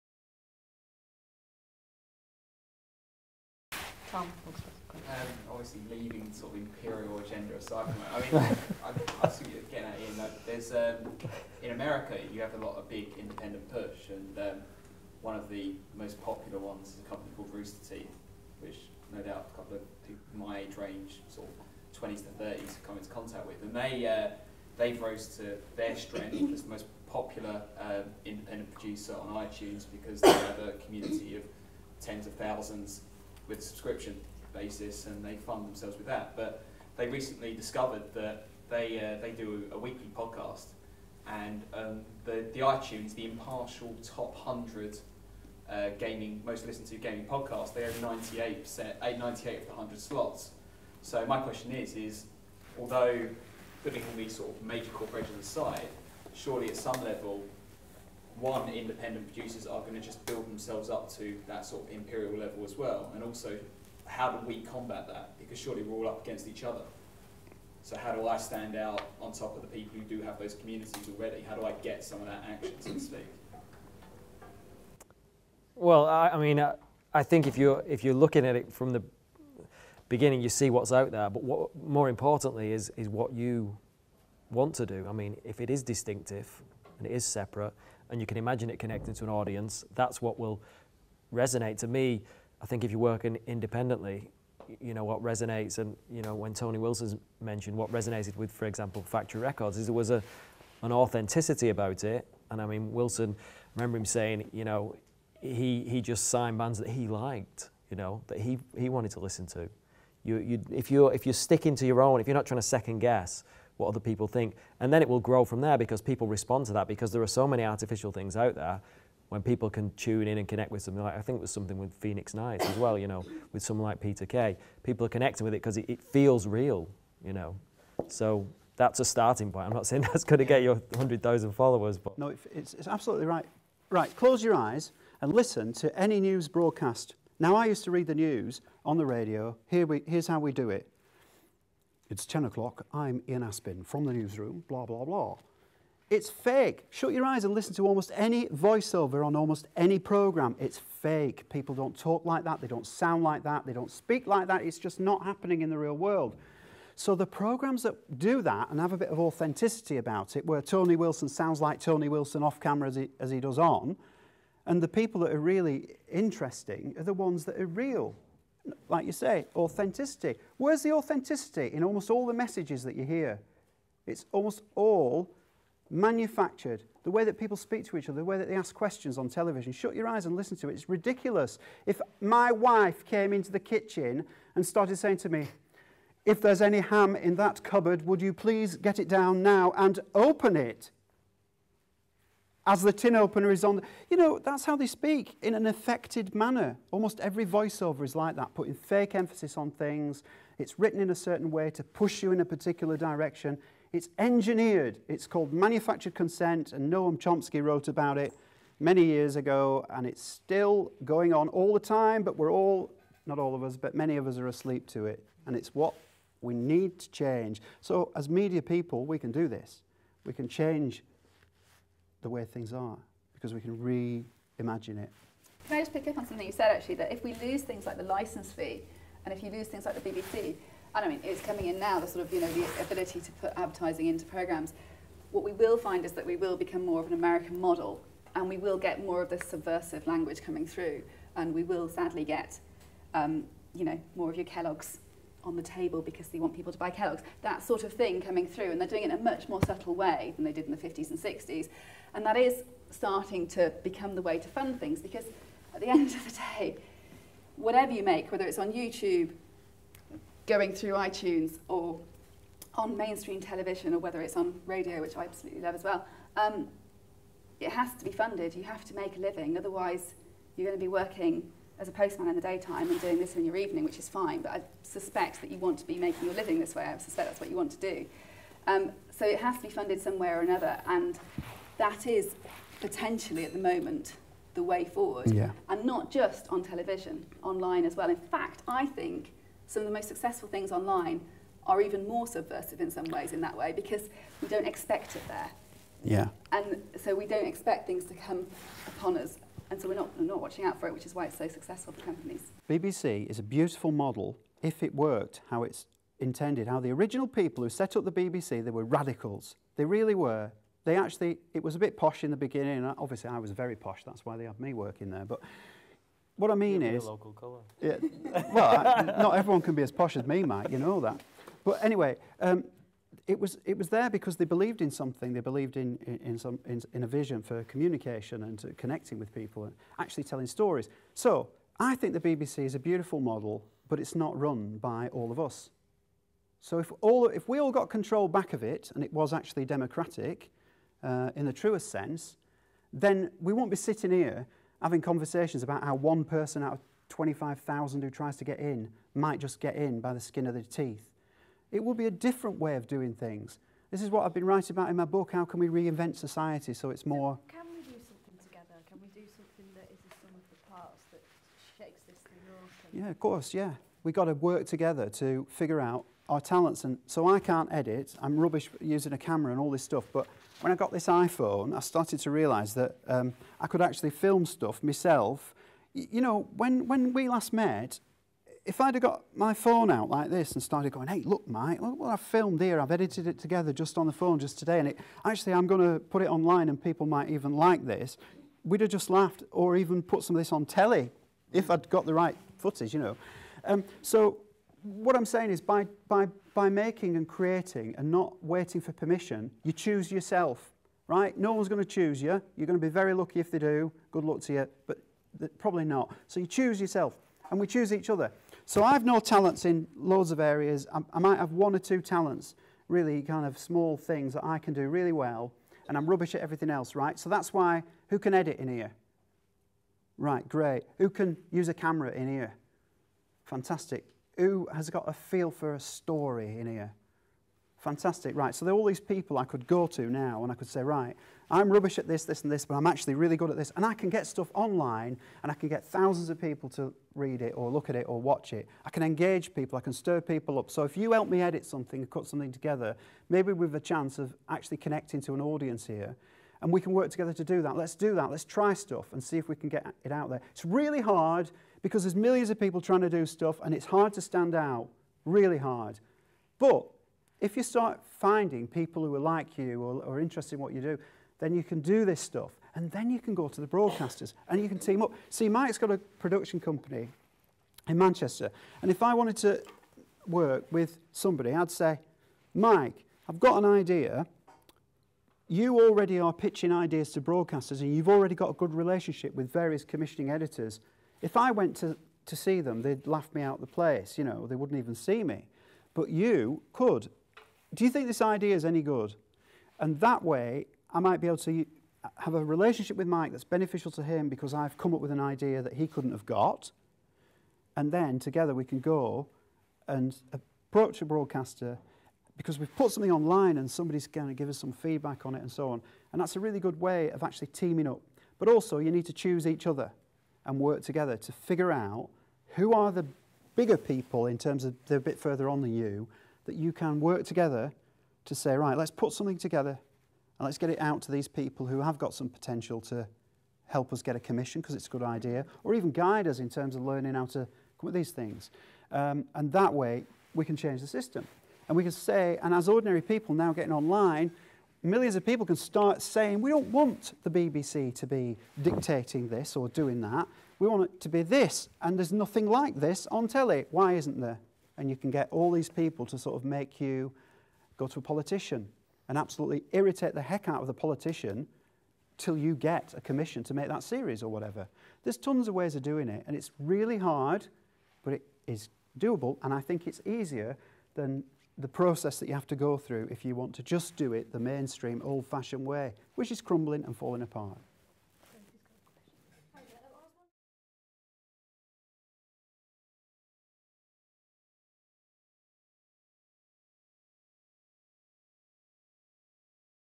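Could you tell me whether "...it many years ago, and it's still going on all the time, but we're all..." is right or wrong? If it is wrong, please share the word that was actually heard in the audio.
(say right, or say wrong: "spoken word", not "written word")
right.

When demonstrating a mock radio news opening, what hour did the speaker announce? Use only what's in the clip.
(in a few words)
10 o'clock.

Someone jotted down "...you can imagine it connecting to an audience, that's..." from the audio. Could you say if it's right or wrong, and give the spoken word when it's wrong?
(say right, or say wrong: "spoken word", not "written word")
right.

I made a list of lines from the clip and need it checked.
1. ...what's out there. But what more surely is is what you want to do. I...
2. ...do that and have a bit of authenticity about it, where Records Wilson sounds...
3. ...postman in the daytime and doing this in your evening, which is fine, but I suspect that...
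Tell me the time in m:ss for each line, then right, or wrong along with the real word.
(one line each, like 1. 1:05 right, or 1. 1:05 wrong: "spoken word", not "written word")
1. 1:20 wrong: "importantly", not "surely"
2. 2:38 wrong: "Tony", not "Records"
3. 4:31 right.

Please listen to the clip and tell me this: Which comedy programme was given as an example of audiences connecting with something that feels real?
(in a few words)
Phoenix Nights.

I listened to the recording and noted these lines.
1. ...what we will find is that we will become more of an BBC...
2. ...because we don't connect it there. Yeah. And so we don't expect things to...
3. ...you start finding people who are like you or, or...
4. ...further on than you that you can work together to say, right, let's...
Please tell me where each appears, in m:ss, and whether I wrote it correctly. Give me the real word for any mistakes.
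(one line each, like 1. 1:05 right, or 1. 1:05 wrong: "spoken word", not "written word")
1. 3:55 wrong: "American", not "BBC"
2. 4:53 wrong: "expect", not "connect"
3. 7:37 right
4. 8:35 right.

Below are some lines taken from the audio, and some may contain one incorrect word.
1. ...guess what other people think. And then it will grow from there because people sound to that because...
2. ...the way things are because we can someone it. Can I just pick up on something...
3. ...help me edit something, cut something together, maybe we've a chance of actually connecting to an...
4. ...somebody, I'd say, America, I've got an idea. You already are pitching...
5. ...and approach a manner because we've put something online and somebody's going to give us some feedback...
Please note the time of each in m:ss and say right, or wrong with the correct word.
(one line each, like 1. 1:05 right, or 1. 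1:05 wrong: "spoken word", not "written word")
1. 1:52 wrong: "respond", not "sound"
2. 3:42 wrong: "reimagine", not "someone"
3. 7:21 right
4. 7:51 wrong: "Mike", not "America"
5. 8:19 wrong: "broadcaster", not "manner".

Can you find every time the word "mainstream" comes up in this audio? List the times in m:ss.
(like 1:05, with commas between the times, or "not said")
4:22, 9:24.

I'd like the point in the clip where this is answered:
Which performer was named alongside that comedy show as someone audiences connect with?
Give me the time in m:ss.
2:03.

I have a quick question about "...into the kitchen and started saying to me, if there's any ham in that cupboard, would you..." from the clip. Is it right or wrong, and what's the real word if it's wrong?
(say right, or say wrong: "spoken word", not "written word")
right.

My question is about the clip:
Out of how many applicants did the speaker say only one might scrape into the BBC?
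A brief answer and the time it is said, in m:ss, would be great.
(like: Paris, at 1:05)
25,000, at 5:47.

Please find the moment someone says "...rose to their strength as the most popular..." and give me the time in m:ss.
0:25.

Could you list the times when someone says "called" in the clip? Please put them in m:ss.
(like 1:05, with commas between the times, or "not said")
0:17, 3:25.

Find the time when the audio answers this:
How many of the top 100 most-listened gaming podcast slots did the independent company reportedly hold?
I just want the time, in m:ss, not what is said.
0:49.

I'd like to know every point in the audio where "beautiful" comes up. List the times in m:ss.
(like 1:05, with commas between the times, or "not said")
5:03, 5:32.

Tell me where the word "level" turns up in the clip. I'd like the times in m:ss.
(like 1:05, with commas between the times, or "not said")
0:57, 1:02.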